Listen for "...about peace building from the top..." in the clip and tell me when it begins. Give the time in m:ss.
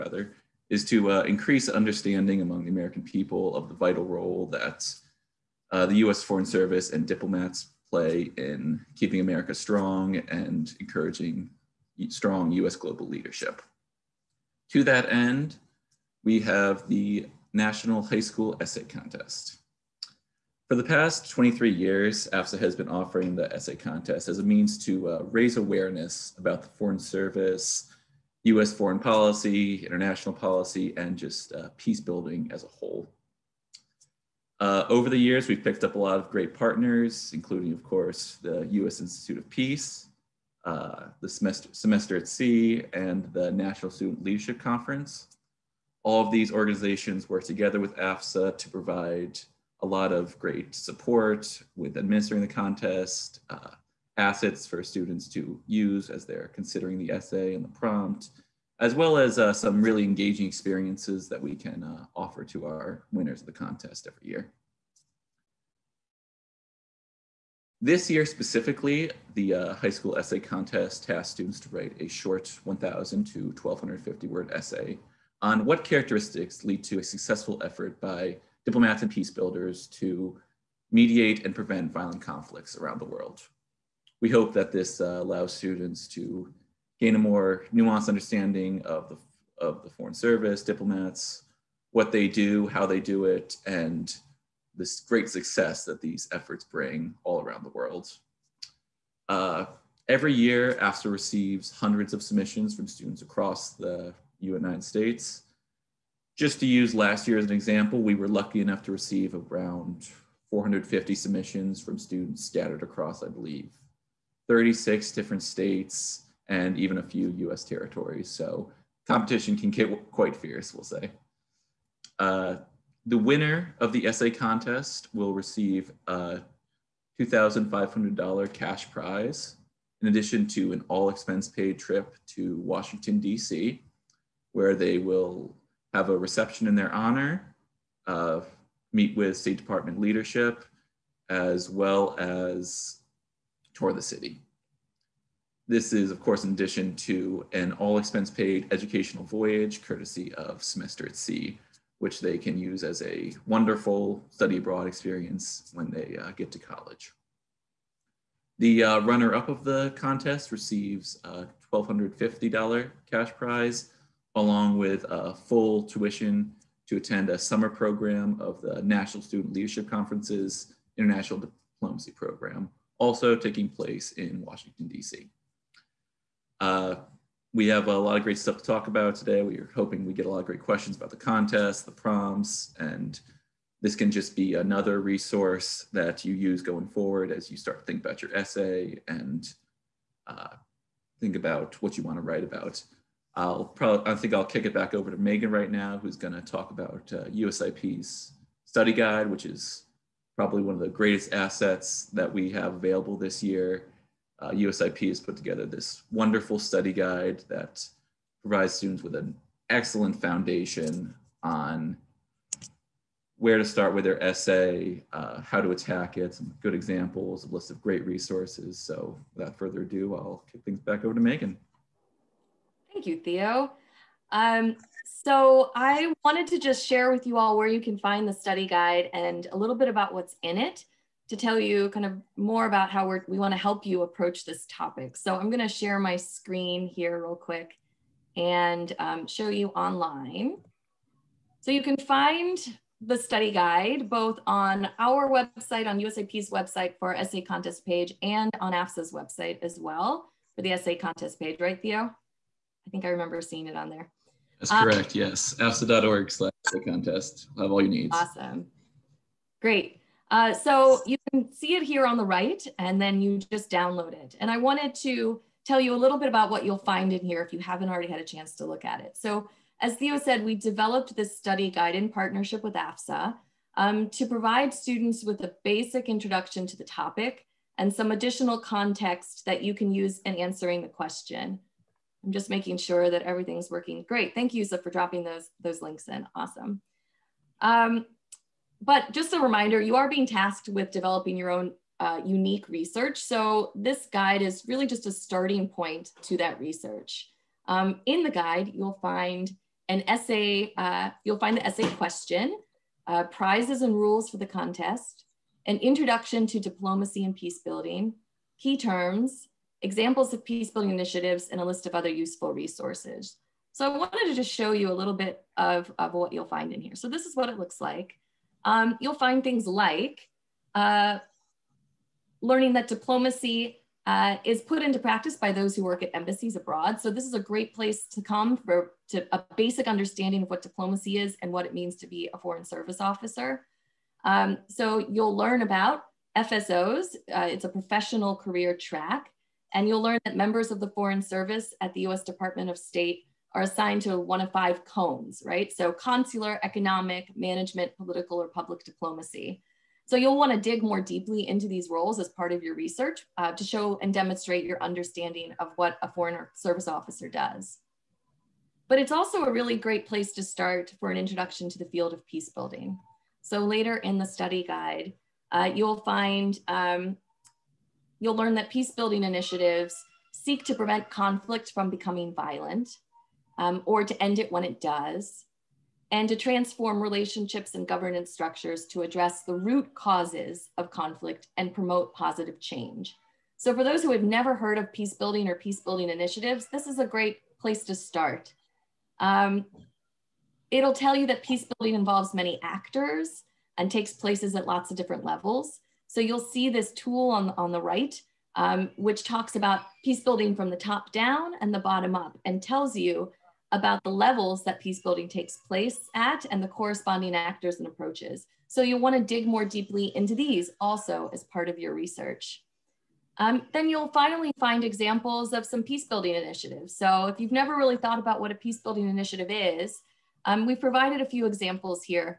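6:39.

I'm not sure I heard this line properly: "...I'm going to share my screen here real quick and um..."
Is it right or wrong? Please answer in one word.
right.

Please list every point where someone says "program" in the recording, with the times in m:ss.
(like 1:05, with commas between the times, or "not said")
2:47, 2:52.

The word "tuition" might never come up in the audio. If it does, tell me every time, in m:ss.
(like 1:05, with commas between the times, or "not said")
2:45.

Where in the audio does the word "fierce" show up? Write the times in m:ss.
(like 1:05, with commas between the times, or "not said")
2:00.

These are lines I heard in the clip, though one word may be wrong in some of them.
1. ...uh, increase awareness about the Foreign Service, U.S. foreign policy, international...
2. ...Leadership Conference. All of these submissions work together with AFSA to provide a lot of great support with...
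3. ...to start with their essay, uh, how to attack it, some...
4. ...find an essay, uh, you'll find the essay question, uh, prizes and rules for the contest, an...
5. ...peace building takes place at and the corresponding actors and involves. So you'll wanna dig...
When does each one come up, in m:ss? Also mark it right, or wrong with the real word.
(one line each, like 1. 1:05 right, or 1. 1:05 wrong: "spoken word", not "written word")
1. 0:25 wrong: "raise", not "increase"
2. 0:44 wrong: "organizations", not "submissions"
3. 3:33 right
4. 4:59 right
5. 6:44 wrong: "approaches", not "involves".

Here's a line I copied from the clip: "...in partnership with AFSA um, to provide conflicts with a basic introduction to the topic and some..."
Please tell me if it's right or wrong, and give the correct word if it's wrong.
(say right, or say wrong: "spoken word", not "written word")
wrong: "students", not "conflicts".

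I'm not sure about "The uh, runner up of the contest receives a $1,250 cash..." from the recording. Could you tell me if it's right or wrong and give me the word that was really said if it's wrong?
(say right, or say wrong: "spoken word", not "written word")
right.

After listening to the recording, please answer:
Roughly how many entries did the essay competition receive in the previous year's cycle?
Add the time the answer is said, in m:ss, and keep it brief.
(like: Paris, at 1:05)
450, at 1:50.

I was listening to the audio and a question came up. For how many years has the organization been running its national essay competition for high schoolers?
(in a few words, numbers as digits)
23.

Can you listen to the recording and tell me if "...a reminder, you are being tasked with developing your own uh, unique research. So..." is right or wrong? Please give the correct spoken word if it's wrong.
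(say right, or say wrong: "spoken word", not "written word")
right.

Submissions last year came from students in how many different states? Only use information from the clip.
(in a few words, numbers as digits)
36.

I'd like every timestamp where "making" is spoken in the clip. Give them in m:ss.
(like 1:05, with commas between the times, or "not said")
4:42.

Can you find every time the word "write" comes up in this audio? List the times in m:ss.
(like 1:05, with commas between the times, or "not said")
1:11, 3:12.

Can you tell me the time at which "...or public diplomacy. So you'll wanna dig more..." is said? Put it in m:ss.
5:48.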